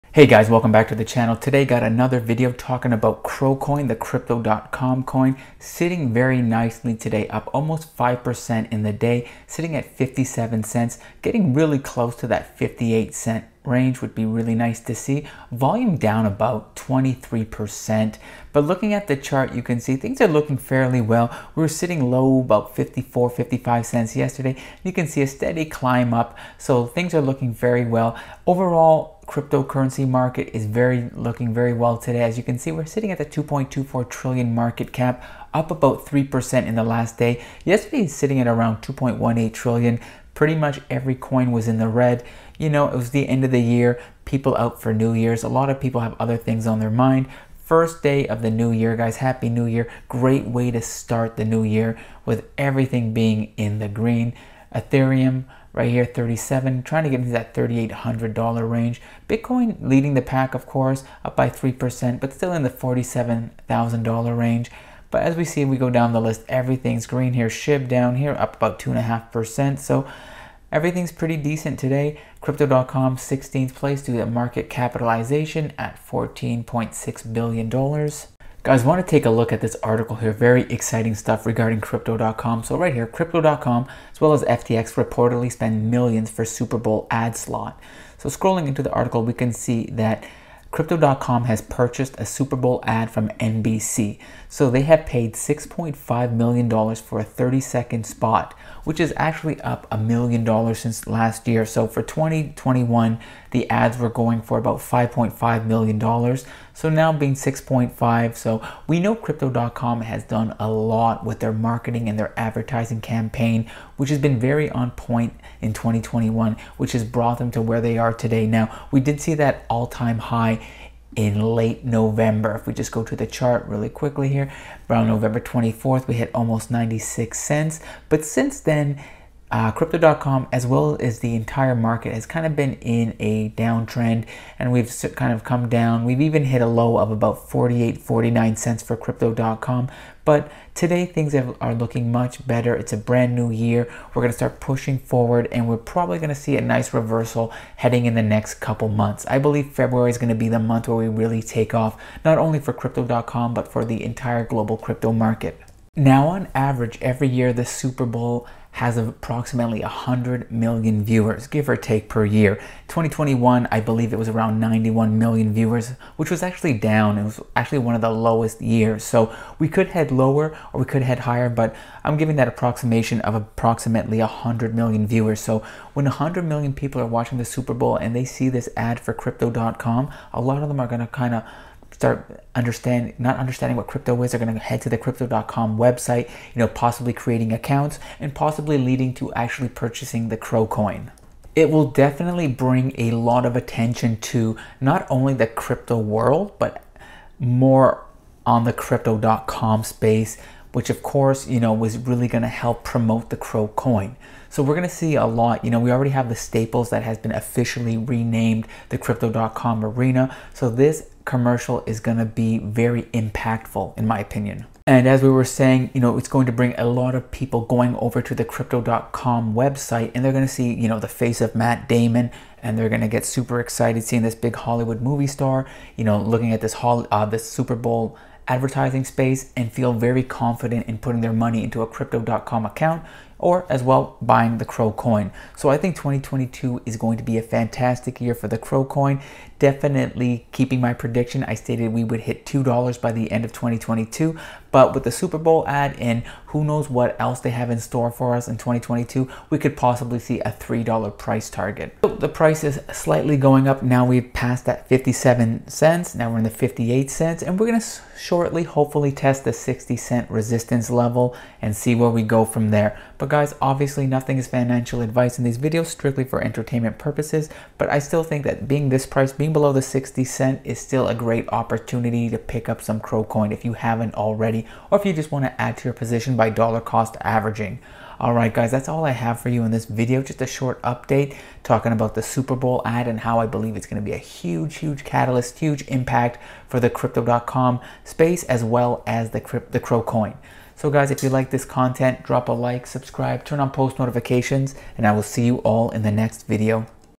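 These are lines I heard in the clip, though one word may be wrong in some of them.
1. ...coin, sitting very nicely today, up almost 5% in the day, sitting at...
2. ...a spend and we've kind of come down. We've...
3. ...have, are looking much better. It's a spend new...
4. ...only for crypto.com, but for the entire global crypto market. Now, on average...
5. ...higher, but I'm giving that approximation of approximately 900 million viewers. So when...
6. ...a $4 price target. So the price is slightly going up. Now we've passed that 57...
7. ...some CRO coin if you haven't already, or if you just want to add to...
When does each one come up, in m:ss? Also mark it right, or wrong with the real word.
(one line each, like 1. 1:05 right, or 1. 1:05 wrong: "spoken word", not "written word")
1. 0:05 right
2. 2:13 wrong: "downtrend", not "spend"
3. 2:21 wrong: "brand", not "spend"
4. 2:32 right
5. 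2:51 wrong: "100", not "900"
6. 4:10 wrong: "3", not "4"
7. 4:32 right.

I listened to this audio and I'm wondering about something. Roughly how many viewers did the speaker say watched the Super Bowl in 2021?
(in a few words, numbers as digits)
91 million.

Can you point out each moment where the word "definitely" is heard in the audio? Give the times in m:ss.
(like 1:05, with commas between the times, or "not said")
3:11, 3:59.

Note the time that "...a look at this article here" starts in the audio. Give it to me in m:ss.
1:19.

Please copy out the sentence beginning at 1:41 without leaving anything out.
So for 2021, the ads were going for about $5.5 million, so now being 6.5.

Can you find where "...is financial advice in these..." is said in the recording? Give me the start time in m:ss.
4:24.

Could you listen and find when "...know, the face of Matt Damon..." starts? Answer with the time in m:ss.
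3:40.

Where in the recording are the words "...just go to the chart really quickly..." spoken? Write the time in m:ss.
2:02.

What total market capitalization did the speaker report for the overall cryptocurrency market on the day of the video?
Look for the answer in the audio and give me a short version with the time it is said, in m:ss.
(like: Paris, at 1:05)
2.24 trillion, at 0:33.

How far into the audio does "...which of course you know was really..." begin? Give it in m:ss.
3:20.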